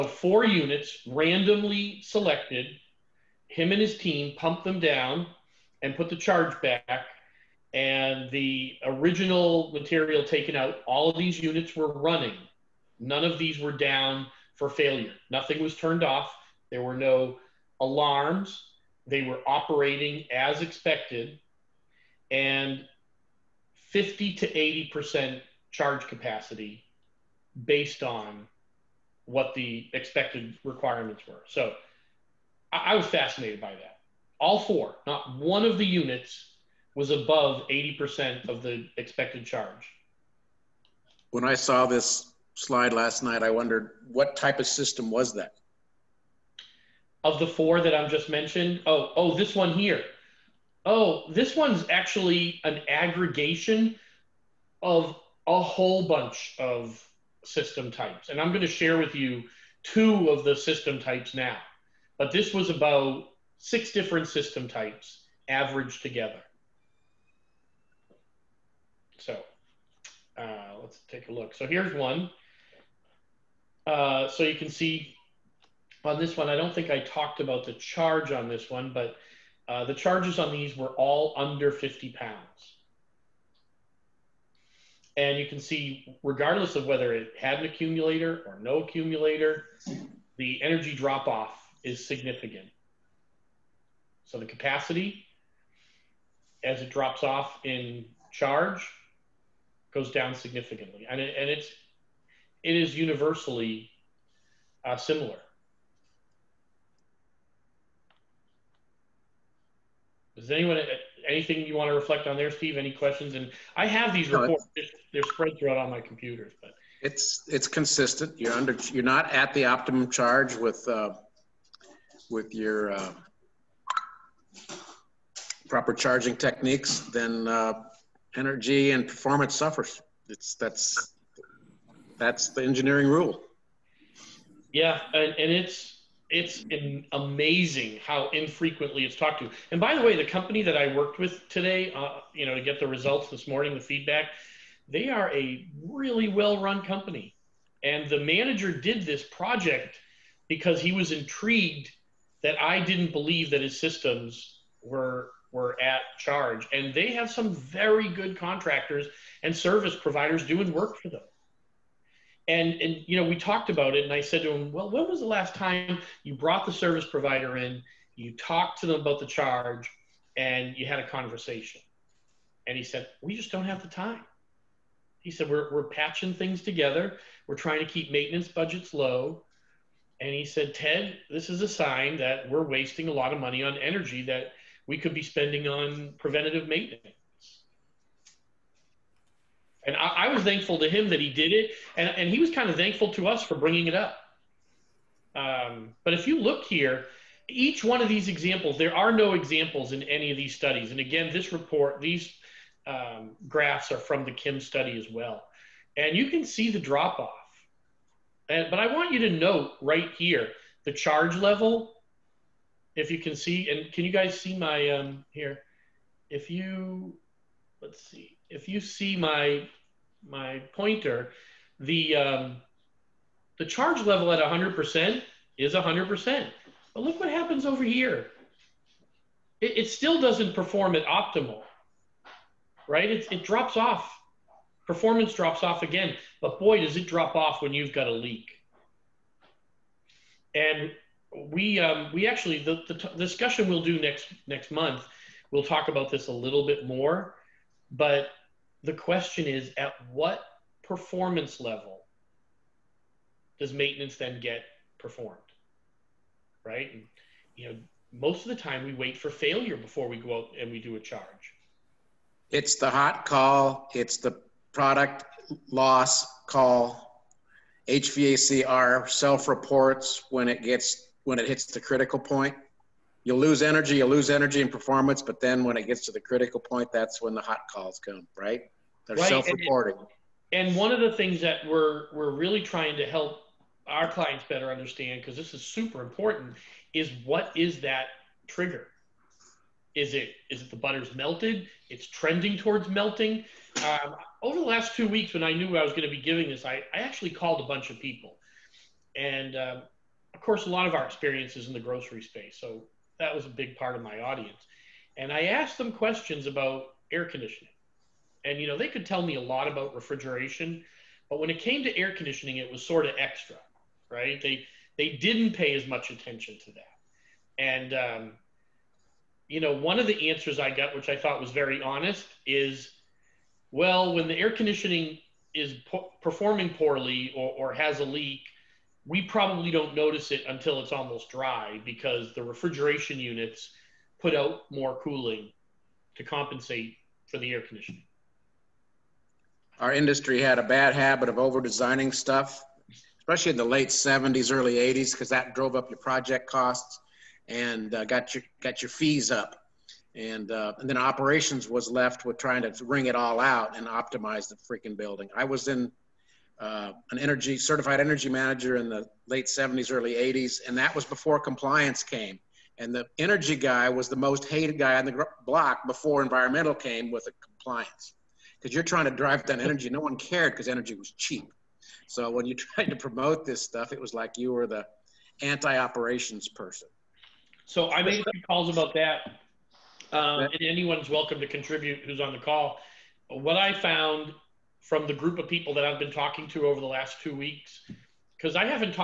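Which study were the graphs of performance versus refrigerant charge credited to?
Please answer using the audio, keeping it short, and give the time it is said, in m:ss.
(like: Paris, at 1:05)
Kim study, at 3:24.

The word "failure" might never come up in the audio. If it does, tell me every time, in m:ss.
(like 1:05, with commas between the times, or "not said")
0:14, 4:19.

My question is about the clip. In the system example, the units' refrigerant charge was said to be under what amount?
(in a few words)
50 pounds.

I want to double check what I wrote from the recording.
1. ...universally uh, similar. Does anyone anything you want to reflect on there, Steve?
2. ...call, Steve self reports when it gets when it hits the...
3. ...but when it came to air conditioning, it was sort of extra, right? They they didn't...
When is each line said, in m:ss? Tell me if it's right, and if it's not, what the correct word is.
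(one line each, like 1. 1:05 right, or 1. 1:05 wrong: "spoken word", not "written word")
1. 1:42 right
2. 4:26 wrong: "HVACR", not "Steve"
3. 5:11 right.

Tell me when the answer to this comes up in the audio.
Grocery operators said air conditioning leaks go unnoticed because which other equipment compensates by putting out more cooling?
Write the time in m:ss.
5:32.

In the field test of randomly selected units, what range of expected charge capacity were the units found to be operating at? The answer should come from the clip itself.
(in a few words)
50 to 80%.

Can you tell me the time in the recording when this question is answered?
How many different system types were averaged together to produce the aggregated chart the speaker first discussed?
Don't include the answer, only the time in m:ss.
1:03.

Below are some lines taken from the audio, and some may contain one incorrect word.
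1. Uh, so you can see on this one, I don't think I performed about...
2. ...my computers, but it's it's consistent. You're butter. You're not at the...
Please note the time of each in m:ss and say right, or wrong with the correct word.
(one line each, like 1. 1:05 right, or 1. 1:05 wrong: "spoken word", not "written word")
1. 1:13 wrong: "talked", not "performed"
2. 1:55 wrong: "under", not "butter".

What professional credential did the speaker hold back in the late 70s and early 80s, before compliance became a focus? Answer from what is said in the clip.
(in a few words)
certified energy manager.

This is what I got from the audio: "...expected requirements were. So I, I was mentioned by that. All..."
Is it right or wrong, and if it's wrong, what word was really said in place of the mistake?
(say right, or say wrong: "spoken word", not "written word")
wrong: "fascinated", not "mentioned".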